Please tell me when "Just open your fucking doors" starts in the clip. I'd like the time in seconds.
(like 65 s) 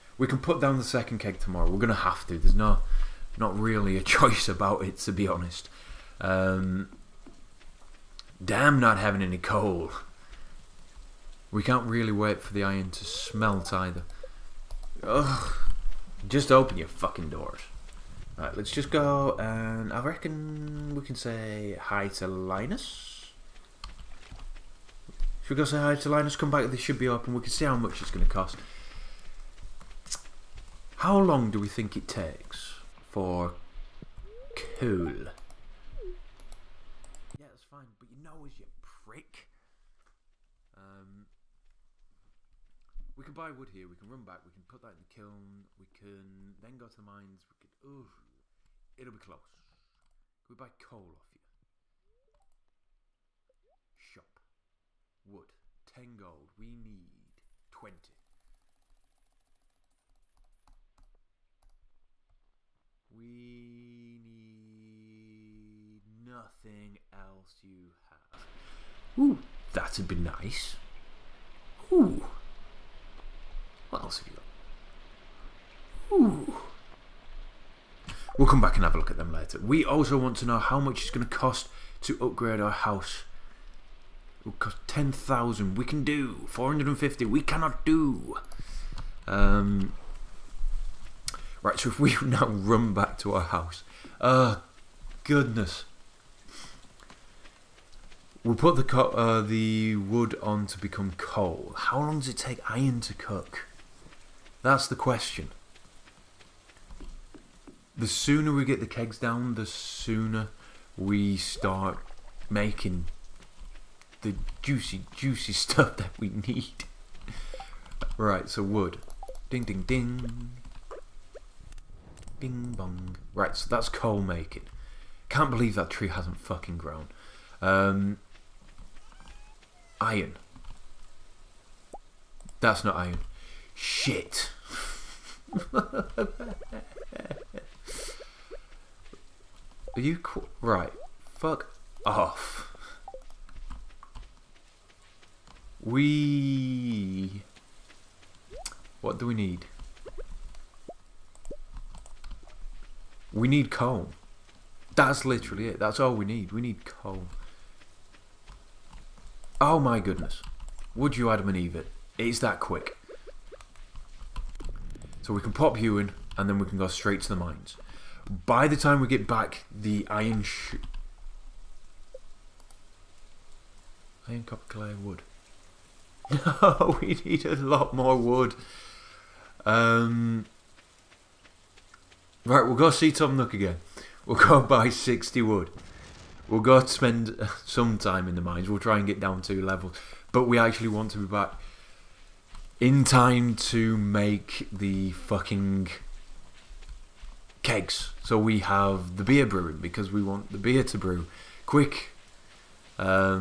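16 s.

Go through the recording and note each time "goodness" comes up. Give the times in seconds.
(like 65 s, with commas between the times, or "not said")
95 s, 160 s.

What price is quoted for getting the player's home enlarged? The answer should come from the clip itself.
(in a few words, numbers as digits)
10,000.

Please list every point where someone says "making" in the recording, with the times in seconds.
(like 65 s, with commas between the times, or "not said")
112 s, 124 s.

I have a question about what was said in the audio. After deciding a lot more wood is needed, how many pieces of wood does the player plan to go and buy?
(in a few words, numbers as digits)
60.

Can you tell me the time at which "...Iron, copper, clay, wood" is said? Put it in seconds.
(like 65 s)
174 s.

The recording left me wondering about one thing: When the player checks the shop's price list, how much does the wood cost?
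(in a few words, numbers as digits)
10 gold.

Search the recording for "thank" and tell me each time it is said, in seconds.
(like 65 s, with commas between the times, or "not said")
not said.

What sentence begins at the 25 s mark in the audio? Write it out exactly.
Should we go say hi to Linus?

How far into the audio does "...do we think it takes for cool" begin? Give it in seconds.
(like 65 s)
31 s.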